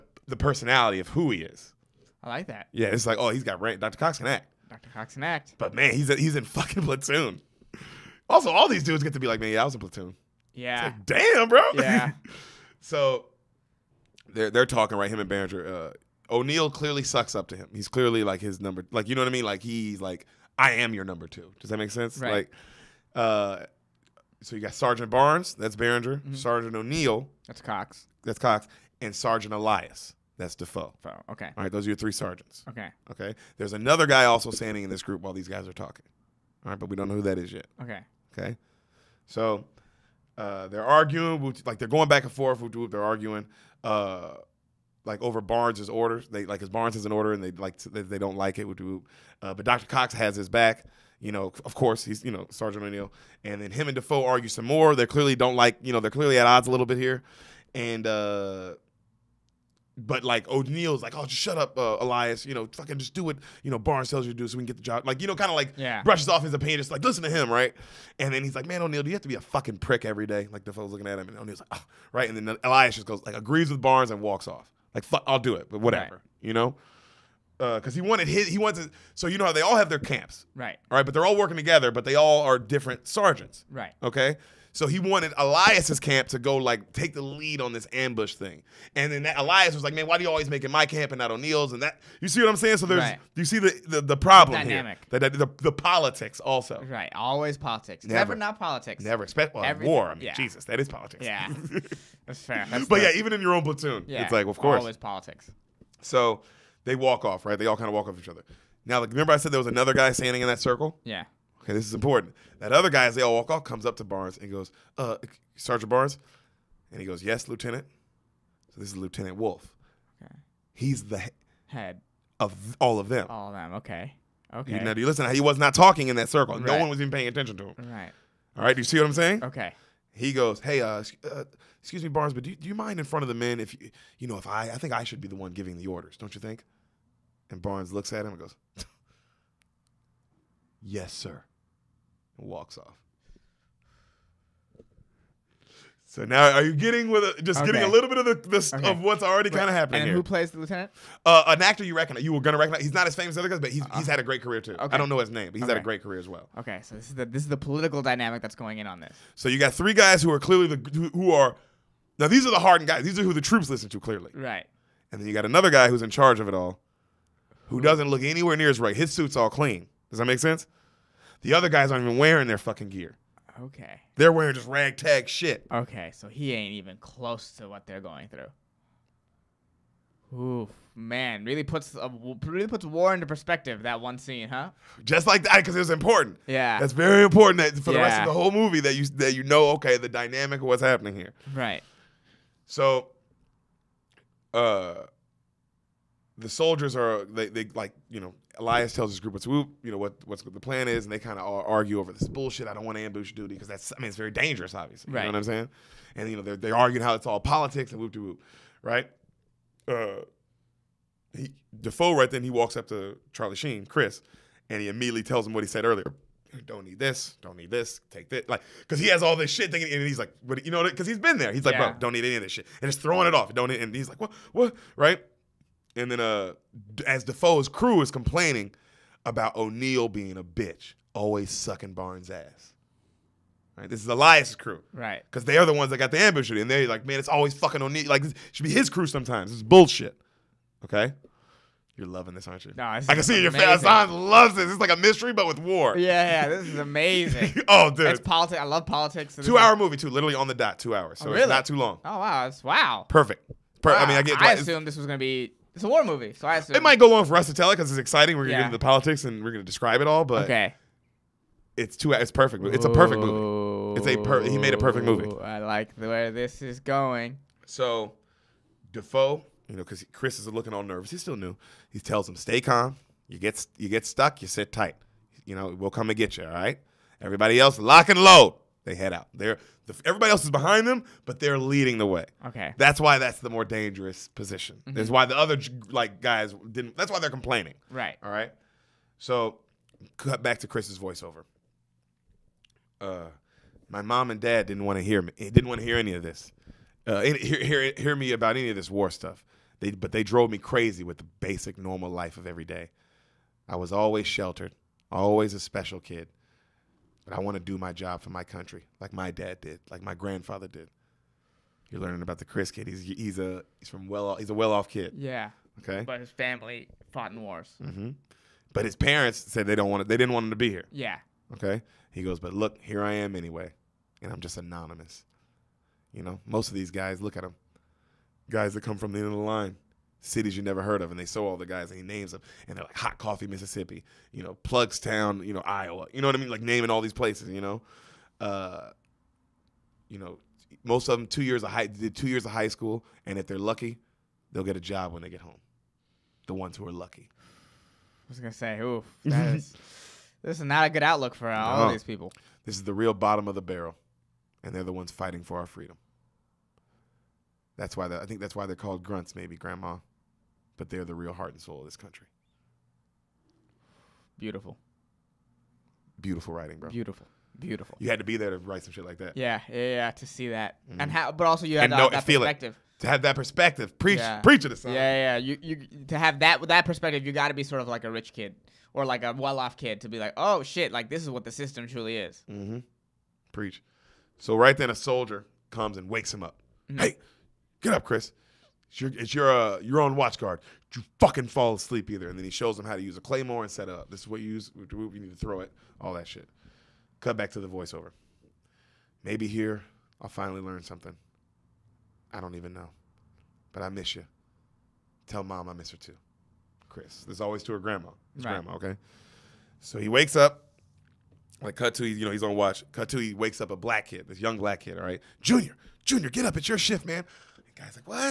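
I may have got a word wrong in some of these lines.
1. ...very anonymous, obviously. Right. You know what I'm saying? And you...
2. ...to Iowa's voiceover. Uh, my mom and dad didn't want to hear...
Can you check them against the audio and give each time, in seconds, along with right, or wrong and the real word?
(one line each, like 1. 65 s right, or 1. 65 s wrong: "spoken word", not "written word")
1. 204 s wrong: "dangerous", not "anonymous"
2. 290 s wrong: "Chris", not "Iowa".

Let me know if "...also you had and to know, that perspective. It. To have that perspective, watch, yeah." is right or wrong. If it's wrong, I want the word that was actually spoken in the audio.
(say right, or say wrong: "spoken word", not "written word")
wrong: "preach", not "watch".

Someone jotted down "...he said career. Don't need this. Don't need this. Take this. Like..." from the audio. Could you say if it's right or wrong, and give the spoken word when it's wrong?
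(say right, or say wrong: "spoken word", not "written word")
wrong: "earlier", not "career".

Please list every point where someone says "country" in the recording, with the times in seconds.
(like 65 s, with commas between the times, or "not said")
308 s, 361 s.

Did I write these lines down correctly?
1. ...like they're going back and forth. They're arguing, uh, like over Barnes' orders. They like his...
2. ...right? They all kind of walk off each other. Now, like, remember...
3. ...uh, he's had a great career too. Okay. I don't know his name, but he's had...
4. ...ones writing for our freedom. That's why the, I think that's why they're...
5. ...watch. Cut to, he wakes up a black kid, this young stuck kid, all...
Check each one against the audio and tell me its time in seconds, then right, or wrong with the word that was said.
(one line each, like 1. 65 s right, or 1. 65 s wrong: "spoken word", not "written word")
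1. 41 s right
2. 107 s right
3. 153 s right
4. 354 s wrong: "fighting", not "writing"
5. 412 s wrong: "black", not "stuck".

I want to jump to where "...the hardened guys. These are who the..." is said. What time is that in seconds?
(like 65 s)
162 s.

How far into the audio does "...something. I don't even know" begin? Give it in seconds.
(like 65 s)
400 s.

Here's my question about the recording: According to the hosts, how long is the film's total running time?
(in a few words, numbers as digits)
2 hours.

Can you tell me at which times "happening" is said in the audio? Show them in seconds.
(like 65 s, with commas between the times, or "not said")
149 s, 190 s.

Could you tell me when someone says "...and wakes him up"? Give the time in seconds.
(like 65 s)
385 s.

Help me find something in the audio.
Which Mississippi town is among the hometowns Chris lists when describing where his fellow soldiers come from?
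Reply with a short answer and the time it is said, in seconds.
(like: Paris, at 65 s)
Hot Coffee, at 332 s.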